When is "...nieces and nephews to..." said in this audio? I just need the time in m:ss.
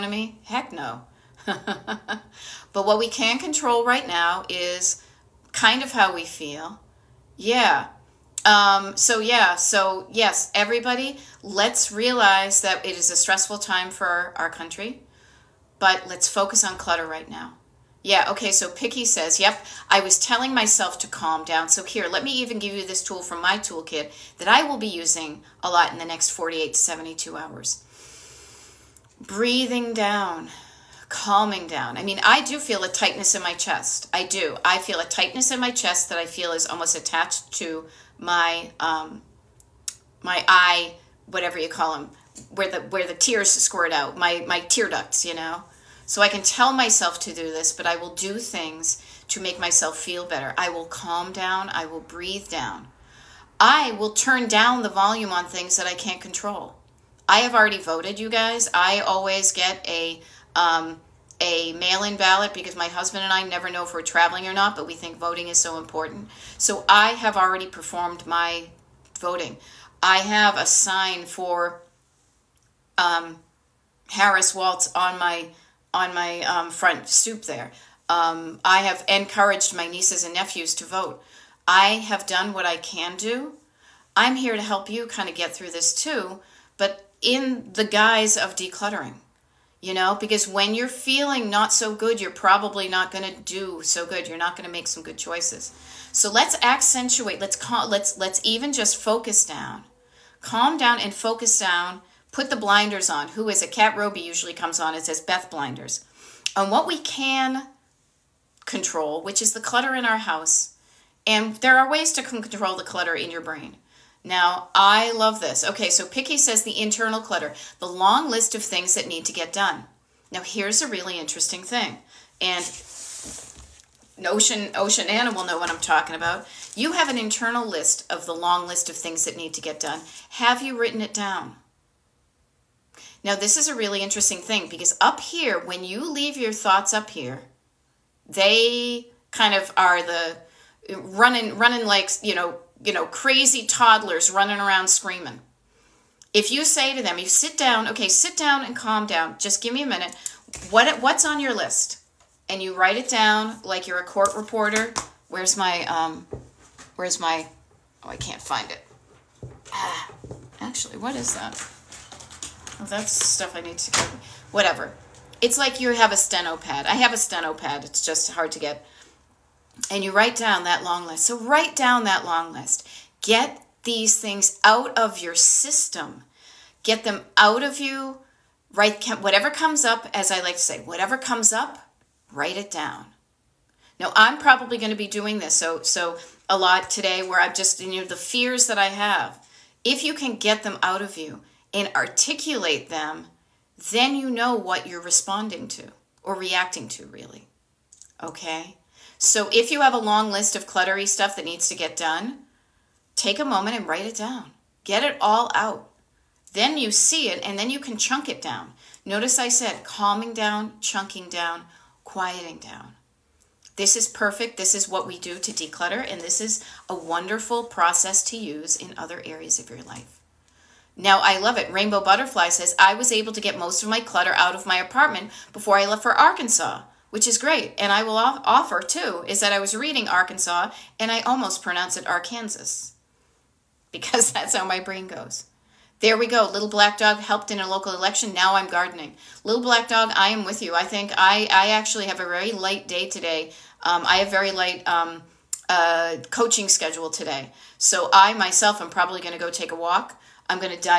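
1:19.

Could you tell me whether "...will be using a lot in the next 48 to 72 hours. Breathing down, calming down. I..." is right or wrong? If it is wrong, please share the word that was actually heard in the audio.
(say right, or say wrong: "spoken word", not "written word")
right.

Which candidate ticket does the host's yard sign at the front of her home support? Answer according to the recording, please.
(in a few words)
Harris Waltz.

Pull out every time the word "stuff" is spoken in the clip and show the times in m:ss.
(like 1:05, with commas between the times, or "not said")
2:43, 3:21.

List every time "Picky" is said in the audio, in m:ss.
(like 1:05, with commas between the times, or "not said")
0:18, 1:56.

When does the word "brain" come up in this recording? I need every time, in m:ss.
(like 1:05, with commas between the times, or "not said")
1:53, 3:54.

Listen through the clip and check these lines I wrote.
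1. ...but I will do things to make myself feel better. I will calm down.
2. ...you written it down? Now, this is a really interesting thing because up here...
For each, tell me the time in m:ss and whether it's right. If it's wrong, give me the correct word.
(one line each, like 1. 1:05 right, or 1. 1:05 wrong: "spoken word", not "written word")
1. 0:47 right
2. 2:10 right.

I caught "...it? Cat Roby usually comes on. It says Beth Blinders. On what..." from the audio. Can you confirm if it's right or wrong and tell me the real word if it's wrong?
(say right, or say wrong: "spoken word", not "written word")
right.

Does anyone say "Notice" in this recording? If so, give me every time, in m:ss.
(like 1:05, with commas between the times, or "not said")
3:29.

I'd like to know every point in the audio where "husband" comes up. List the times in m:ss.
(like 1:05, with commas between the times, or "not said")
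1:02.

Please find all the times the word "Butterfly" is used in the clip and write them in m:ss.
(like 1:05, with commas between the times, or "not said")
3:42.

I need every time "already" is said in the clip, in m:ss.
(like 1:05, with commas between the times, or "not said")
0:57, 1:07.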